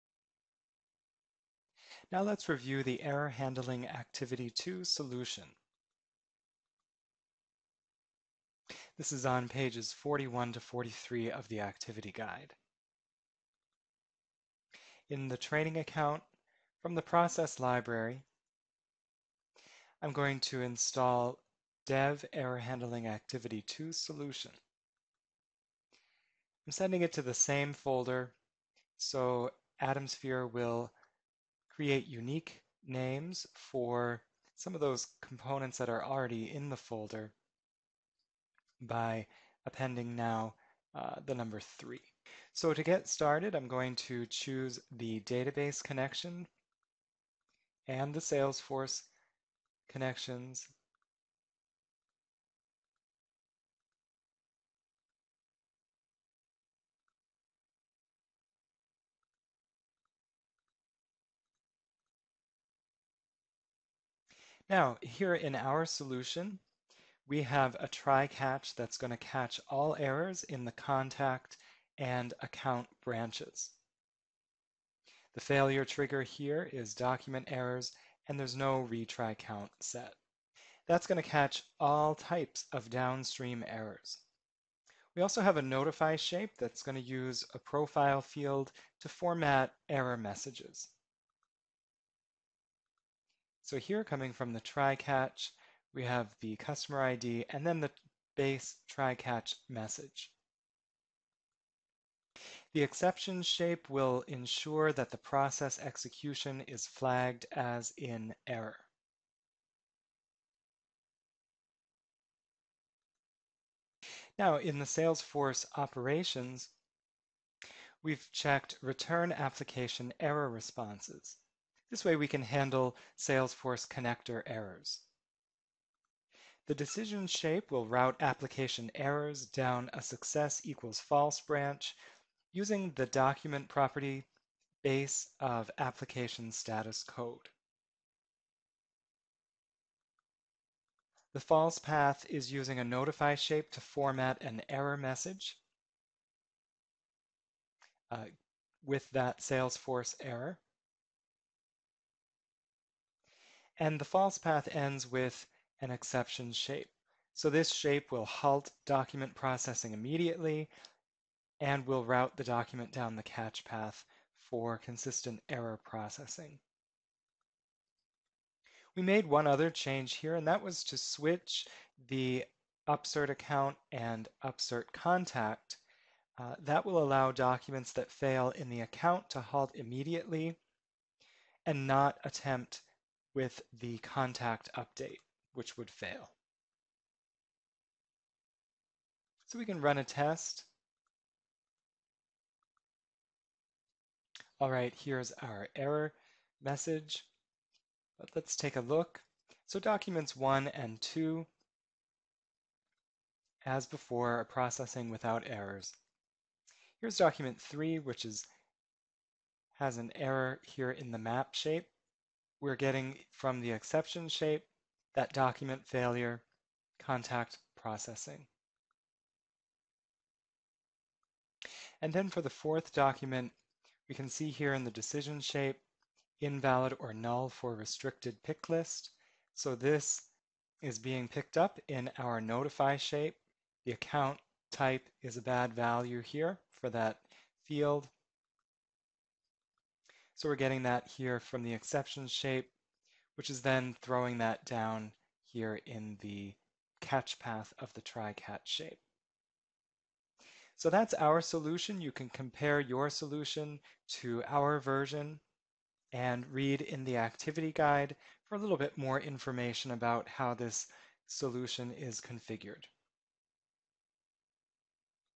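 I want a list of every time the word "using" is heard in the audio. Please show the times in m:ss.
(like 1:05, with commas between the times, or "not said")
2:12, 2:22.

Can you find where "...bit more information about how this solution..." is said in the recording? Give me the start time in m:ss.
4:18.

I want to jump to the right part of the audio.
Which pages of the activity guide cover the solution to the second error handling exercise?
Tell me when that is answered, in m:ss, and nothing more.
0:09.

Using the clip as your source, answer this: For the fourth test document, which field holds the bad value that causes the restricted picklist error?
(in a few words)
Account type.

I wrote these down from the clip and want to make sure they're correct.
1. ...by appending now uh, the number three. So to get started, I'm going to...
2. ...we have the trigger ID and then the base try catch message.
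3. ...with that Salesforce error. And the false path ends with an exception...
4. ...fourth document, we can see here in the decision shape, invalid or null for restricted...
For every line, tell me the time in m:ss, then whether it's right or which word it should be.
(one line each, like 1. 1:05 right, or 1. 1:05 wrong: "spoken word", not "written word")
1. 0:38 right
2. 1:35 wrong: "customer", not "trigger"
3. 2:28 right
4. 3:42 right.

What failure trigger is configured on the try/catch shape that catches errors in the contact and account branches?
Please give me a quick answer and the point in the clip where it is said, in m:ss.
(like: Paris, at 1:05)
Document errors, at 1:16.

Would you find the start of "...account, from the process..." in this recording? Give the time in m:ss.
0:15.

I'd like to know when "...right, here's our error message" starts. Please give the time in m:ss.
3:14.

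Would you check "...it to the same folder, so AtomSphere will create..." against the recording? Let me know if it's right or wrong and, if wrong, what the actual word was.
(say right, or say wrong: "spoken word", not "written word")
right.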